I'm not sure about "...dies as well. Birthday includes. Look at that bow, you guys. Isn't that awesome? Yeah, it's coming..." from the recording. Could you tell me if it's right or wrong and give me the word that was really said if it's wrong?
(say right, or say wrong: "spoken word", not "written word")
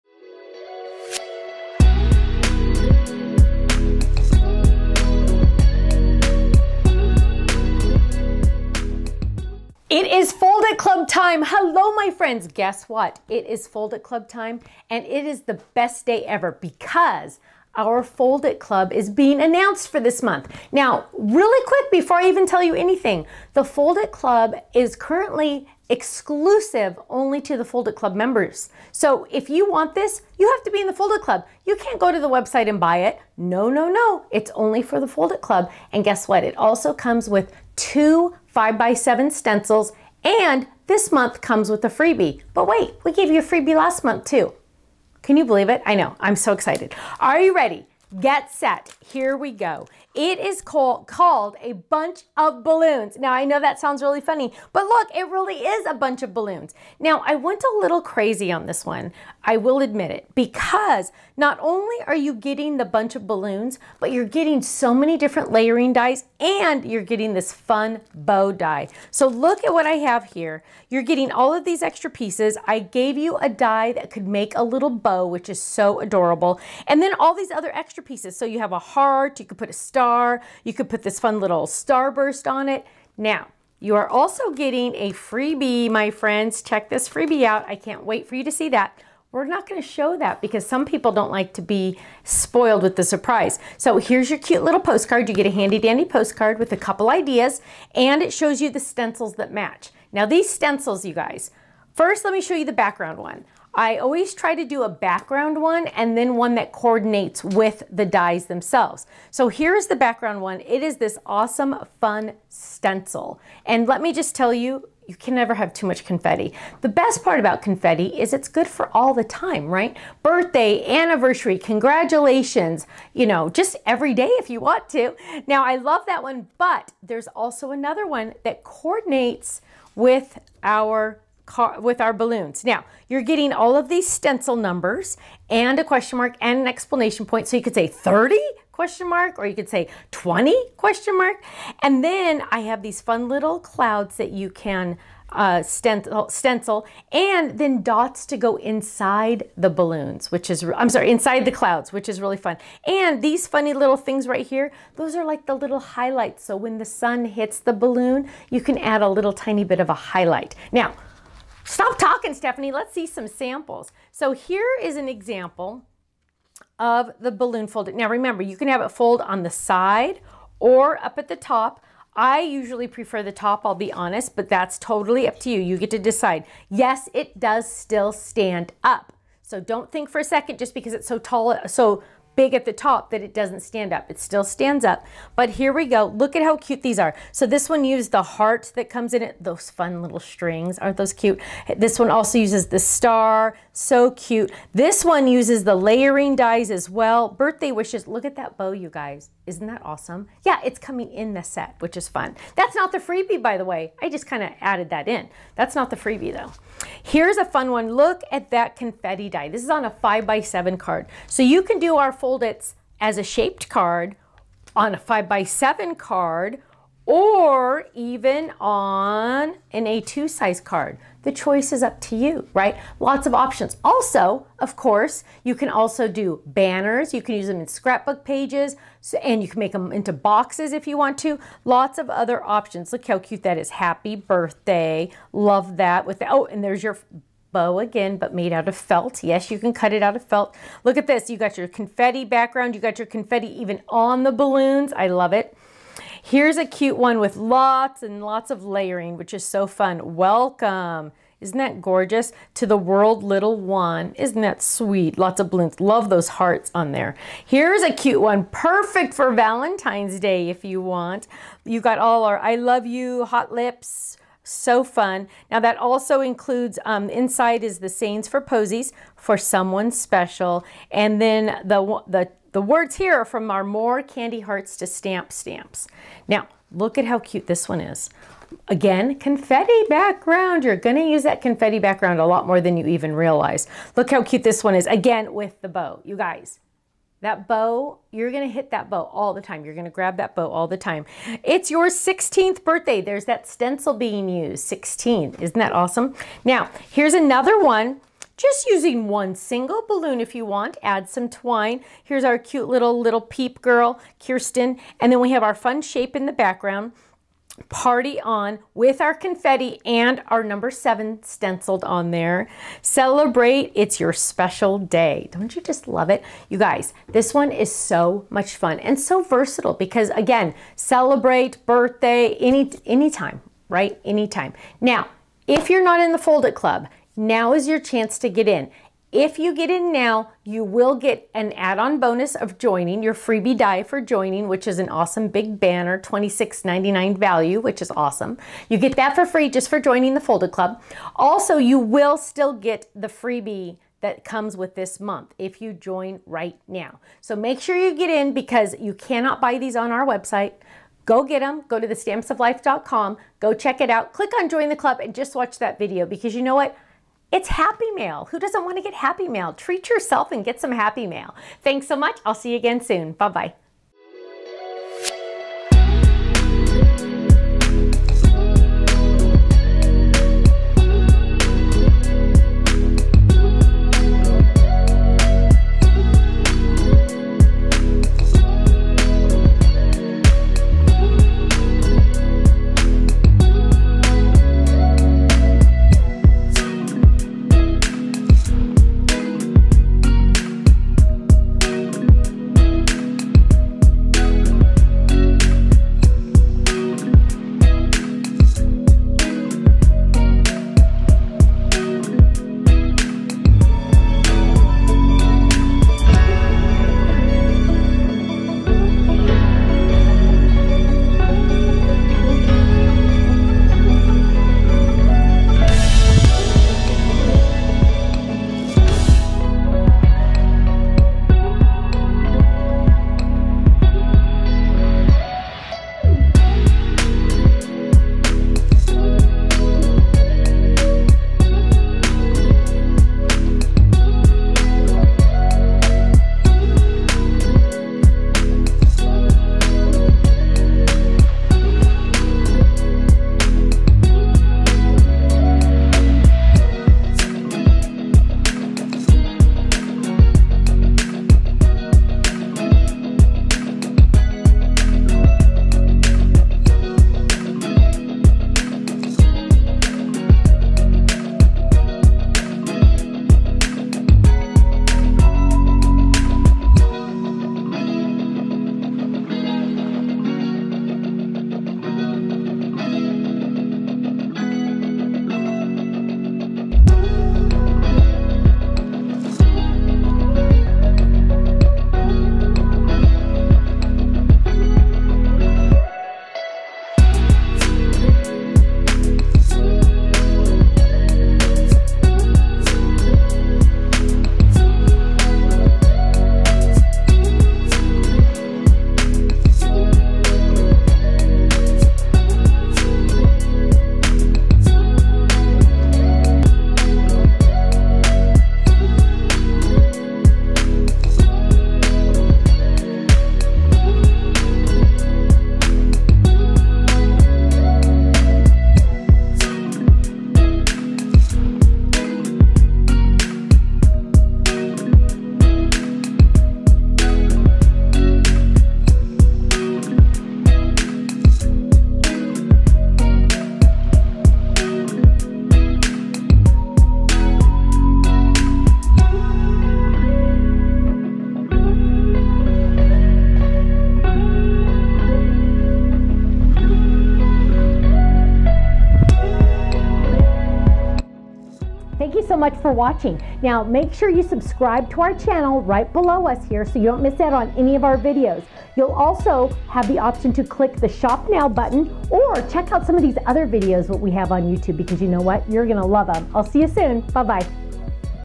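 wrong: "wishes", not "includes".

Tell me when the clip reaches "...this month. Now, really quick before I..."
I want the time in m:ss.
0:20.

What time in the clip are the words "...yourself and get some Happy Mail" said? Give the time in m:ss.
5:59.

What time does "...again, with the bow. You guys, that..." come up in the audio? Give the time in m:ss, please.
4:44.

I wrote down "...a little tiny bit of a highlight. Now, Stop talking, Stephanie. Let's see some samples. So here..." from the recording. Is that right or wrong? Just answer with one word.
right.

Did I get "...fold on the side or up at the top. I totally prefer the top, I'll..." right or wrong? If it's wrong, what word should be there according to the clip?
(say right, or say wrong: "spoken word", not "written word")
wrong: "usually", not "totally".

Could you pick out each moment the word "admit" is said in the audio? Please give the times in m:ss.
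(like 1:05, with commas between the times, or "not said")
0:59.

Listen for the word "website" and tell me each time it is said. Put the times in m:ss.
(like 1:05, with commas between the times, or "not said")
0:32, 5:50.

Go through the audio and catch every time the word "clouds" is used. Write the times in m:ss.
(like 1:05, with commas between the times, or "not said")
2:23, 2:31.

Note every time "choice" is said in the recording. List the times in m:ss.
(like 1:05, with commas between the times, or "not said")
3:41.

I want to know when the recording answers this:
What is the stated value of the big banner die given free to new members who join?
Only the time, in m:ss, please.
5:35.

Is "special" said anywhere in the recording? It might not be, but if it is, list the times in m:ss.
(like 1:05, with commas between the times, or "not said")
4:29, 5:14.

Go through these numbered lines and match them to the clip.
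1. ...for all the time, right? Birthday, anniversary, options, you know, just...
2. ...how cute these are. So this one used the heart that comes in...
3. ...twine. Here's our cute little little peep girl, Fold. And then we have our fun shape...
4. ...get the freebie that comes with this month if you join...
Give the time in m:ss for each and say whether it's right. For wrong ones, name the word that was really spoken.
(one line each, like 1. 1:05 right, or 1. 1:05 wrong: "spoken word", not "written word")
1. 1:58 wrong: "congratulations", not "options"
2. 3:06 right
3. 5:01 wrong: "Kirsten", not "Fold"
4. 5:42 right.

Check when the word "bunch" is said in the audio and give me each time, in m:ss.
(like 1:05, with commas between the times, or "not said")
0:51, 0:55, 1:02.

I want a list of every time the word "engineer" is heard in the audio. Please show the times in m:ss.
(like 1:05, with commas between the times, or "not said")
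not said.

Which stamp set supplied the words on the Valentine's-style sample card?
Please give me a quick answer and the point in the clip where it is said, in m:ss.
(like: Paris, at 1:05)
More Candy Hearts to Stamp, at 4:33.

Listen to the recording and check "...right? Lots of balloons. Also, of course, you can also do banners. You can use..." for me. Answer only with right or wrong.
wrong.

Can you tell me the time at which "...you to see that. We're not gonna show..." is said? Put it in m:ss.
1:28.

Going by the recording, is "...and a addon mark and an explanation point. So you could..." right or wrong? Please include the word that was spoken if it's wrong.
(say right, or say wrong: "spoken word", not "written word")
wrong: "question", not "addon".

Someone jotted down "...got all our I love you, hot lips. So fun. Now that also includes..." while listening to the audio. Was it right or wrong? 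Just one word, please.
right.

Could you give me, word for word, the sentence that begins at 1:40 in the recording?
Now these stencils, you guys, first let me show you the background one.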